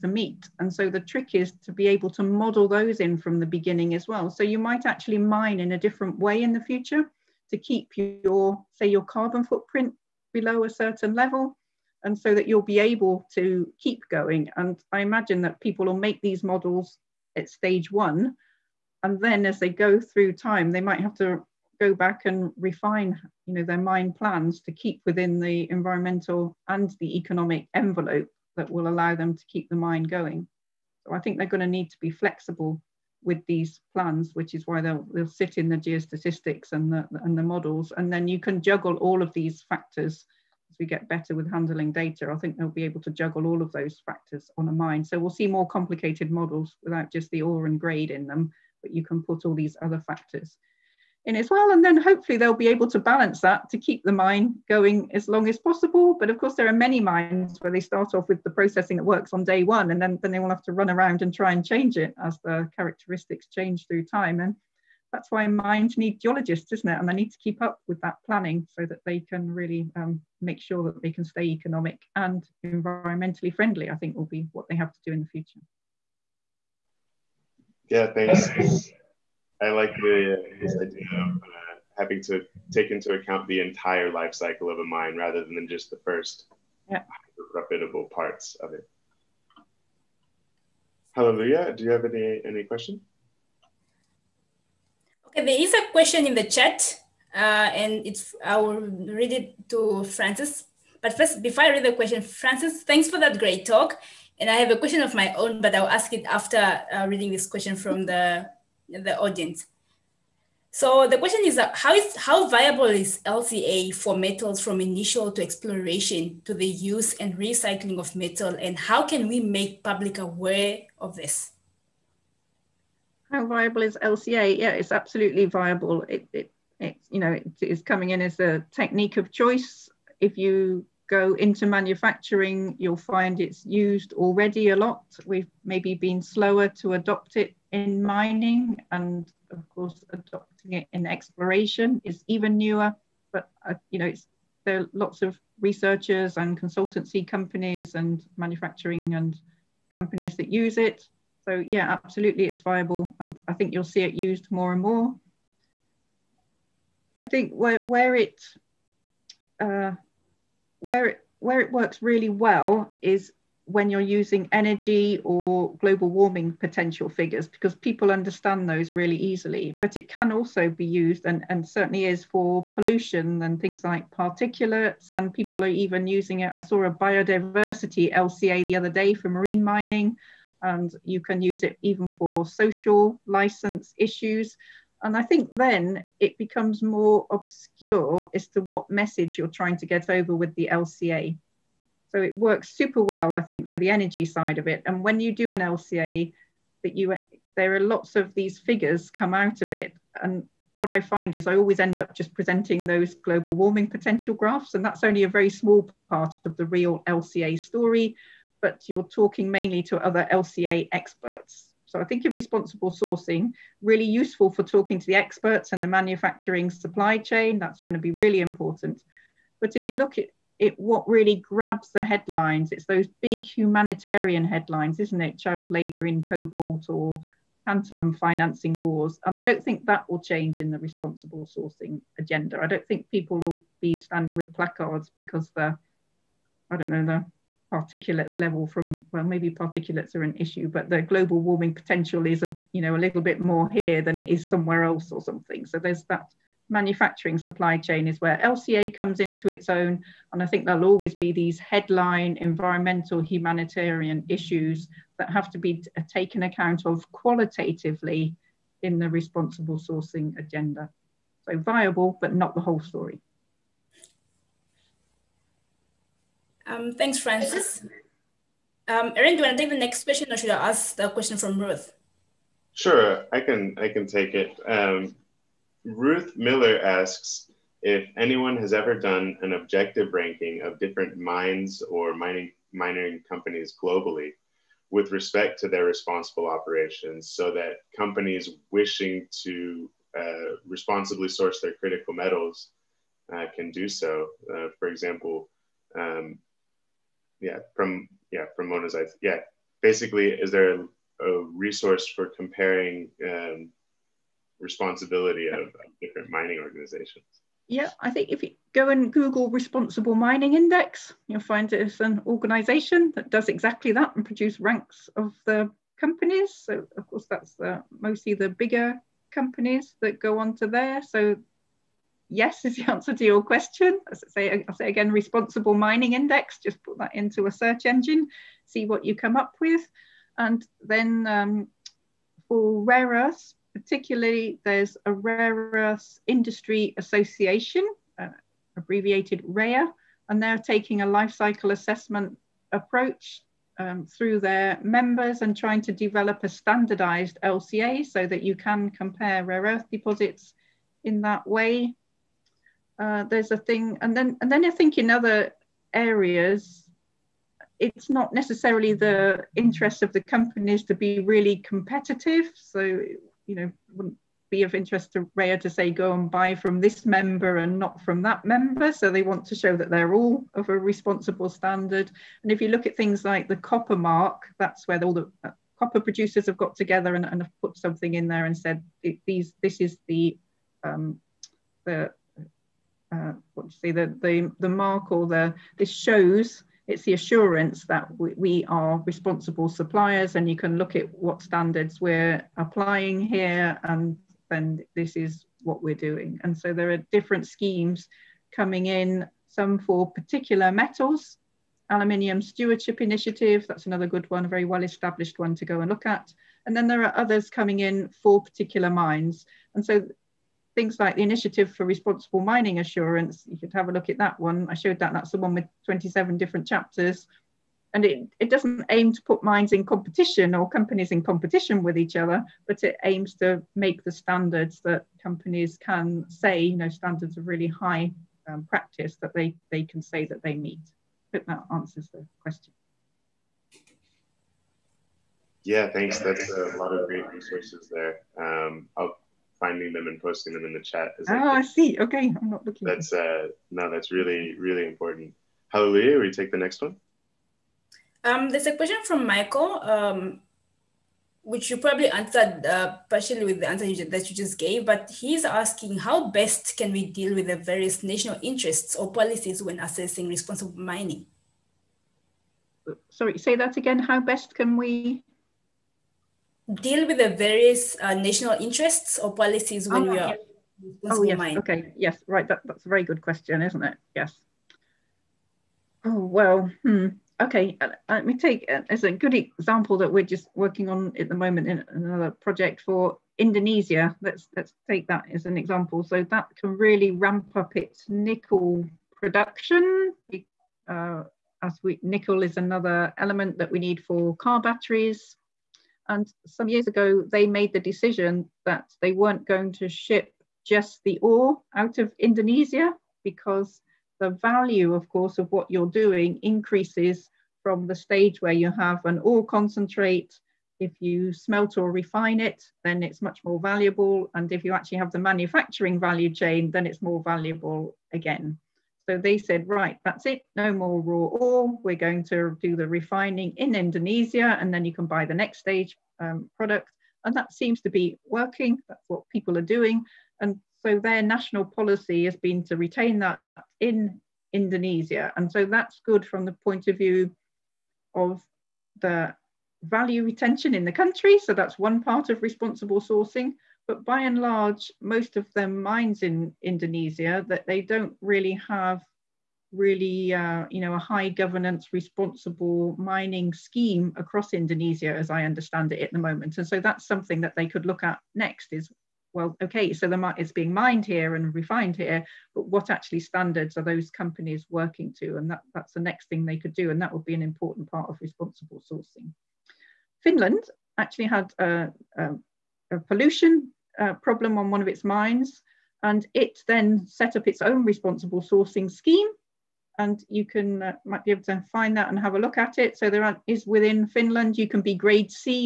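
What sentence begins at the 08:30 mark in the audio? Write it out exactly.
If you smelt or refine it, then it's much more valuable.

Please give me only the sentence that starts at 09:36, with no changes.
And it then set up its own responsible sourcing scheme.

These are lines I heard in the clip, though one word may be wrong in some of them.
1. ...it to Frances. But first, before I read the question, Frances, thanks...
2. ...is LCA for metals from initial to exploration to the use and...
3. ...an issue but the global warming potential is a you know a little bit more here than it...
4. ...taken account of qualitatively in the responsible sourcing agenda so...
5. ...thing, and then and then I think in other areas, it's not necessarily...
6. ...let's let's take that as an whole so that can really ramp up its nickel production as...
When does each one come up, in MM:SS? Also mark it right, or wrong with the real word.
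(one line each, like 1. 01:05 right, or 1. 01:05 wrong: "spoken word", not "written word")
1. 01:39 right
2. 01:52 right
3. 04:00 right
4. 04:16 right
5. 05:53 right
6. 08:04 wrong: "example", not "whole".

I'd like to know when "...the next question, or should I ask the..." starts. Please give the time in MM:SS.
04:29.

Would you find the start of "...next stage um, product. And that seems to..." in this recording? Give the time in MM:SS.
08:45.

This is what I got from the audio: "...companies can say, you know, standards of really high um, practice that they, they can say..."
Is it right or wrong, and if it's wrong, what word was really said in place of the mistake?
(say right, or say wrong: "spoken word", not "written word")
right.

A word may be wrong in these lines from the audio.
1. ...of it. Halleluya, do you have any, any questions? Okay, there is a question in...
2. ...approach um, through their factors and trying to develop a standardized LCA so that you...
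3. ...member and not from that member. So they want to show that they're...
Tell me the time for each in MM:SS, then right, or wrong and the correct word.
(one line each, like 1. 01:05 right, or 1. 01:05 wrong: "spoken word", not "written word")
1. 01:28 right
2. 05:42 wrong: "members", not "factors"
3. 06:07 right.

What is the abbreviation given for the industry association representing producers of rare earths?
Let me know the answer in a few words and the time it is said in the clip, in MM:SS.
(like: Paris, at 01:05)
REA, at 05:39.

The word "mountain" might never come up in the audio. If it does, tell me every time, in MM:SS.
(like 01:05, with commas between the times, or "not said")
not said.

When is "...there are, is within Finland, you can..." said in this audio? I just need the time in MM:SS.
09:43.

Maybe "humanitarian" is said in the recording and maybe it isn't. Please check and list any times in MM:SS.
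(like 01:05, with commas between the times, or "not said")
03:43, 04:13.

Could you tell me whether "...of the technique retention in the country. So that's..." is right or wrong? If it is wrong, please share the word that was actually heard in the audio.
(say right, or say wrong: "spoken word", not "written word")
wrong: "value", not "technique".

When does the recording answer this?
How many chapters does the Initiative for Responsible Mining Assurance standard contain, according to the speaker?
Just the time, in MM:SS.
06:55.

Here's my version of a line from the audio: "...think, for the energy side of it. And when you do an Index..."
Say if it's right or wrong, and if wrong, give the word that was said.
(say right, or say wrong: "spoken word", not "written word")
wrong: "LCA", not "Index".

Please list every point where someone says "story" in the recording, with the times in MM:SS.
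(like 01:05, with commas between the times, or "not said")
03:27, 04:22.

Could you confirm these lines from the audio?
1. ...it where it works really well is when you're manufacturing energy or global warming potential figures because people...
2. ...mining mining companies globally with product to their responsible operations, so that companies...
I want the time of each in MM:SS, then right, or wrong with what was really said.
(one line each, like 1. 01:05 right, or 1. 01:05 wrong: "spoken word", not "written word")
1. 02:41 wrong: "using", not "manufacturing"
2. 04:42 wrong: "respect", not "product".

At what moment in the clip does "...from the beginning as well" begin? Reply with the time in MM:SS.
00:03.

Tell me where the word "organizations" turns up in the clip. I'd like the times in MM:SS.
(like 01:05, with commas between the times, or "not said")
05:06, 05:12.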